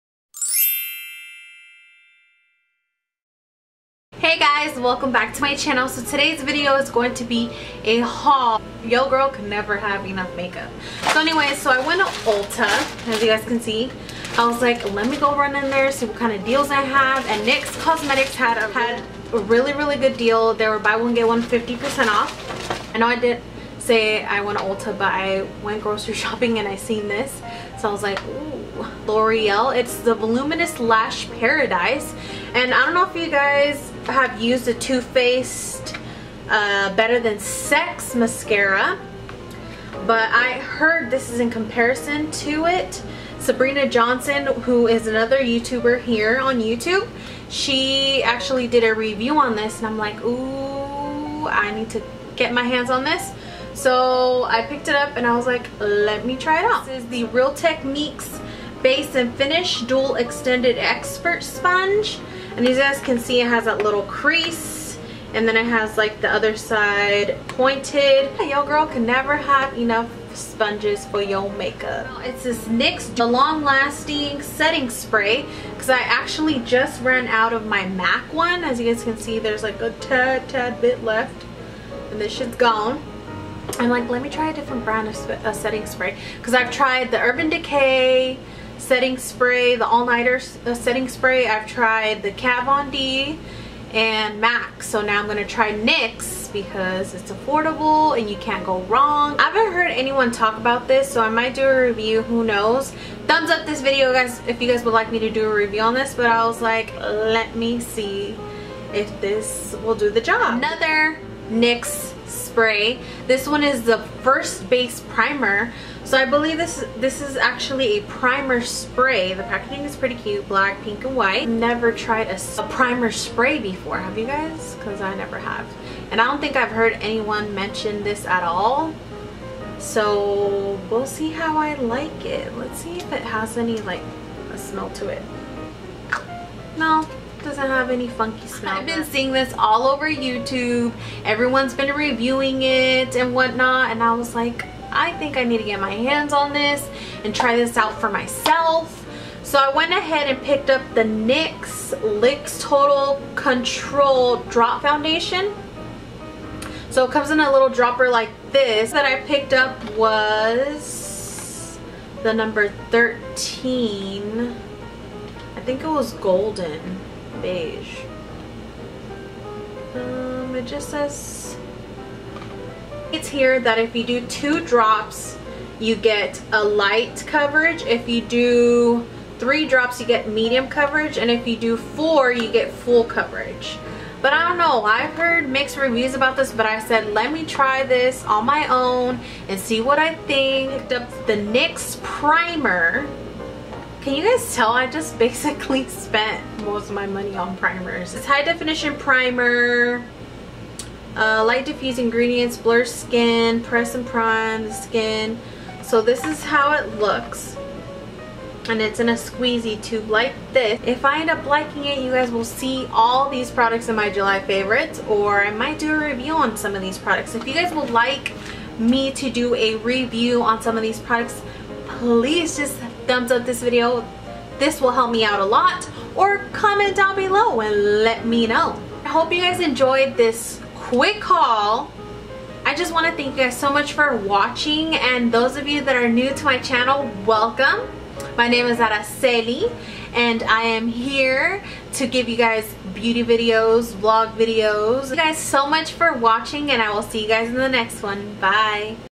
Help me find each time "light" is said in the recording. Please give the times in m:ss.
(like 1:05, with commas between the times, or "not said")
2:56, 3:21.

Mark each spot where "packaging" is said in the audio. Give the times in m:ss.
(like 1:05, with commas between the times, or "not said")
1:59.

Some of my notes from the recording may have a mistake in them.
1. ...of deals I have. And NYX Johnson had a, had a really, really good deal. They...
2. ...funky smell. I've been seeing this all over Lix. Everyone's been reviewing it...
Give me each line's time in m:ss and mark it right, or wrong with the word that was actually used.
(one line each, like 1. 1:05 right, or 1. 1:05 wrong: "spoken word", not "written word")
1. 0:16 wrong: "Cosmetics", not "Johnson"
2. 2:18 wrong: "YouTube", not "Lix".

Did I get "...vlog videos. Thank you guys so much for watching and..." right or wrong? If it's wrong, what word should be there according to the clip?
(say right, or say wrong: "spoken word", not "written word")
right.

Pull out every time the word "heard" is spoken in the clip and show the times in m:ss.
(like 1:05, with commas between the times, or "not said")
0:40, 1:39, 2:06, 3:05.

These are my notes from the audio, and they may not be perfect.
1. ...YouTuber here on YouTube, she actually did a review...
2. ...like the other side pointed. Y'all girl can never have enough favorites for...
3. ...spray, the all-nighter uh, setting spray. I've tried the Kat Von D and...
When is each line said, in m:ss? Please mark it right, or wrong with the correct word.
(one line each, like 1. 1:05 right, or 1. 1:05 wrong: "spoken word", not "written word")
1. 0:45 right
2. 1:05 wrong: "sponges", not "favorites"
3. 1:29 right.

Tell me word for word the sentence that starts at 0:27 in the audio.
So I was like, ooh, L'Oreal.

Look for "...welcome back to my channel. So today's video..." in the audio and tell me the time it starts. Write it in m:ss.
0:04.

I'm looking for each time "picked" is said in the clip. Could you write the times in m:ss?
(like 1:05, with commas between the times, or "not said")
0:54, 2:30, 2:39, 3:10.